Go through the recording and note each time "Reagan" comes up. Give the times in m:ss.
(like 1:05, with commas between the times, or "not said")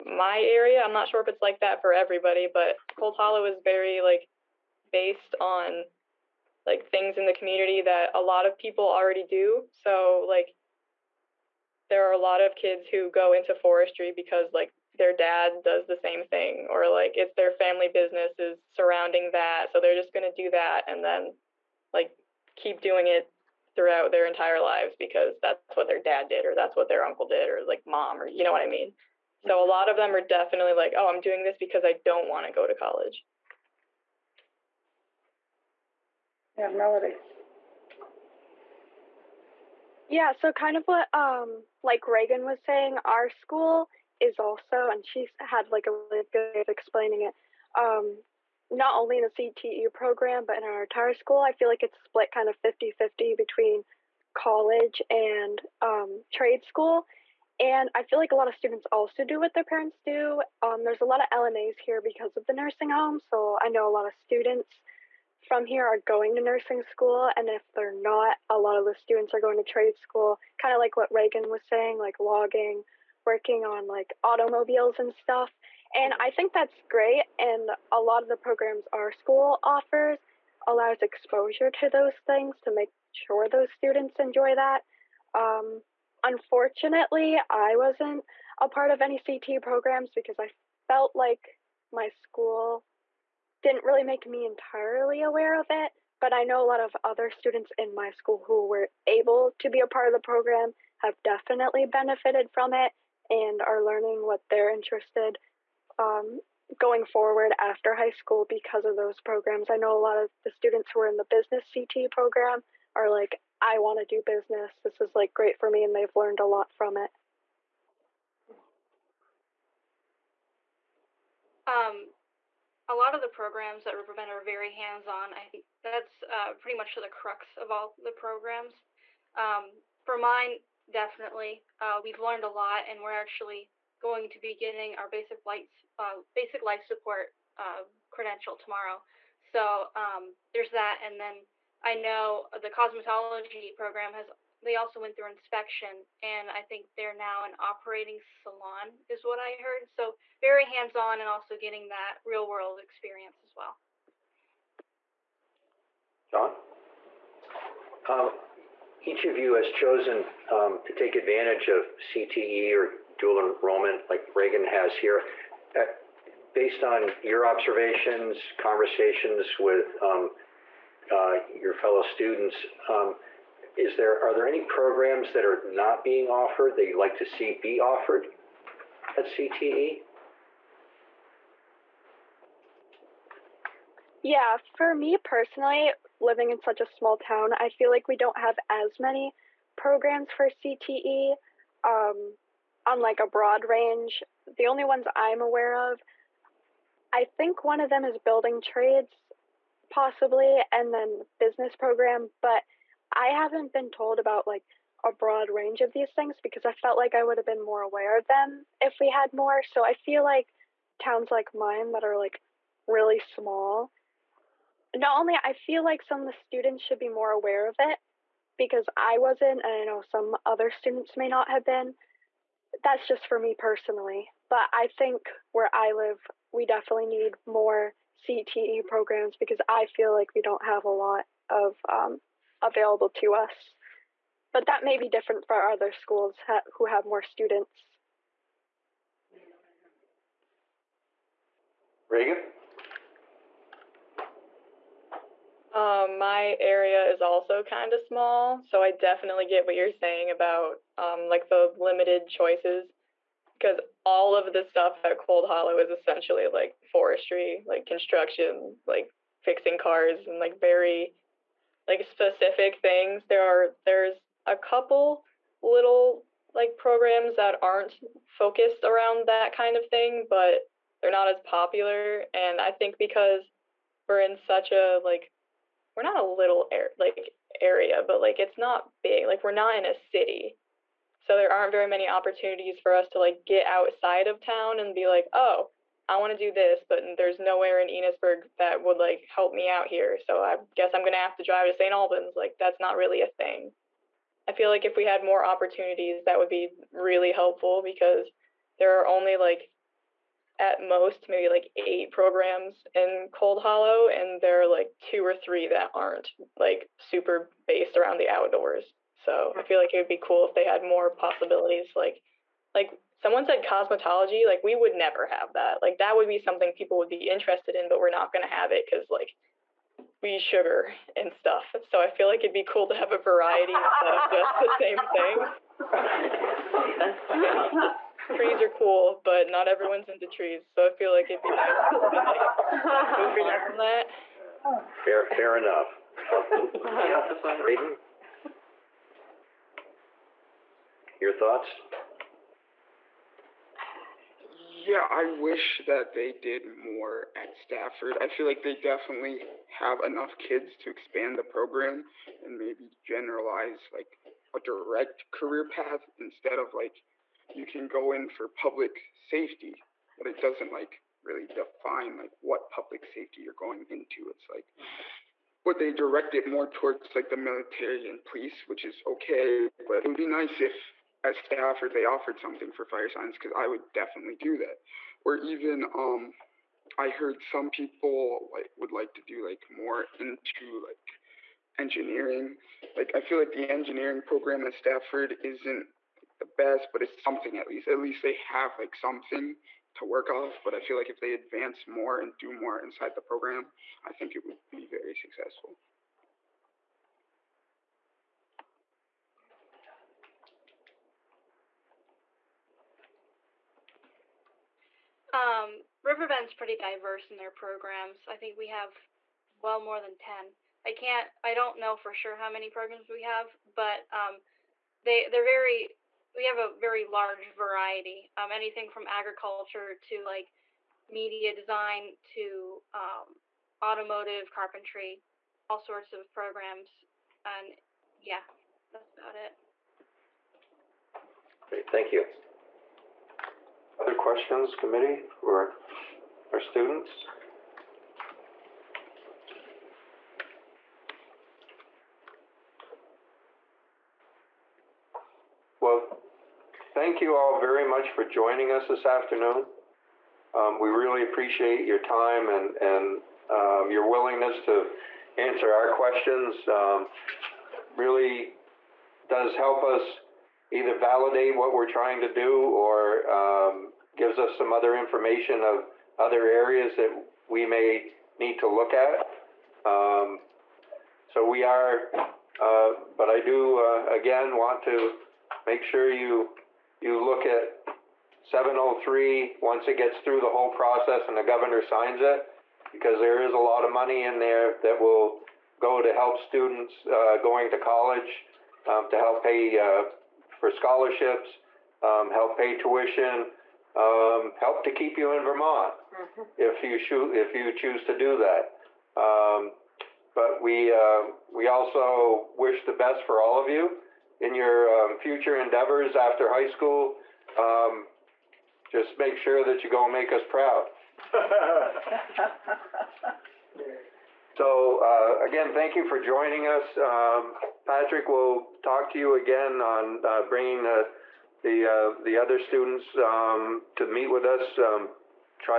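0:42, 1:11, 2:44, 4:02.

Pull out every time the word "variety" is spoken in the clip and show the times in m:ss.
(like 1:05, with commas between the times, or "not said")
5:23, 6:57.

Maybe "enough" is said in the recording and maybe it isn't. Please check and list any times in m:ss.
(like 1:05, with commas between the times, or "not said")
5:35, 5:50.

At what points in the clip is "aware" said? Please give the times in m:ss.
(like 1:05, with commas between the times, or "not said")
1:35, 3:15, 3:27, 3:37.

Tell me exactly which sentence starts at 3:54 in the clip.
But that may be different for other schools ha who have more students.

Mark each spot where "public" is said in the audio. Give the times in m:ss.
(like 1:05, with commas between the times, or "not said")
5:58, 6:02.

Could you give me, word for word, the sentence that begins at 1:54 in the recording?
This is like great for me, and they've learned a lot from it.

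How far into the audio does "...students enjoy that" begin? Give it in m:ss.
1:23.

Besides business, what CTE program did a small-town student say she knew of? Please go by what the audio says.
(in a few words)
building trades.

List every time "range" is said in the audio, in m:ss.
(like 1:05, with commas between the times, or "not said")
3:13, 3:25.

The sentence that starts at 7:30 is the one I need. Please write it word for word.
Um, we really appreciate your time and, and um, your willingness to answer our questions.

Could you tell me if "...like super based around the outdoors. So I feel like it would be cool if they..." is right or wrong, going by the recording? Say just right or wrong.
right.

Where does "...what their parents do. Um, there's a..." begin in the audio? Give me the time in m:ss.
0:59.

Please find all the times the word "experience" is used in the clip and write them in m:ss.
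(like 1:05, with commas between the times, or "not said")
2:32.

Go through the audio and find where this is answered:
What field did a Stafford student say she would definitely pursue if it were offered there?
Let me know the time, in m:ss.
6:12.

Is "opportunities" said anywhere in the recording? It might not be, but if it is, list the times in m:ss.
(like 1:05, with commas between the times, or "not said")
4:42, 4:55.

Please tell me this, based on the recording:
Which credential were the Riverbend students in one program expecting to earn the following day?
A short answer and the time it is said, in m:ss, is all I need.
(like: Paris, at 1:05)
basic life support, at 2:16.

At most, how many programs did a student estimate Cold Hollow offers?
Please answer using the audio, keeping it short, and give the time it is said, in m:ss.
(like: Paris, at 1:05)
8, at 5:01.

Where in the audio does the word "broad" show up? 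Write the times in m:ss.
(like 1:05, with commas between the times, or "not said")
3:13, 3:25.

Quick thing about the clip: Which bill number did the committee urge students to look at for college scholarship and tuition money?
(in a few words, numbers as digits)
703.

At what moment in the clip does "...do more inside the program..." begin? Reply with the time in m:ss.
6:32.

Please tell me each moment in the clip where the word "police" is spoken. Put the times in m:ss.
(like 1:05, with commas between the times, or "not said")
6:08.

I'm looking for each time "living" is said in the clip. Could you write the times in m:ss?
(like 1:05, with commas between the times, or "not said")
3:06.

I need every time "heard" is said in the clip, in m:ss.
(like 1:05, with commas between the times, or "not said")
2:29, 6:17.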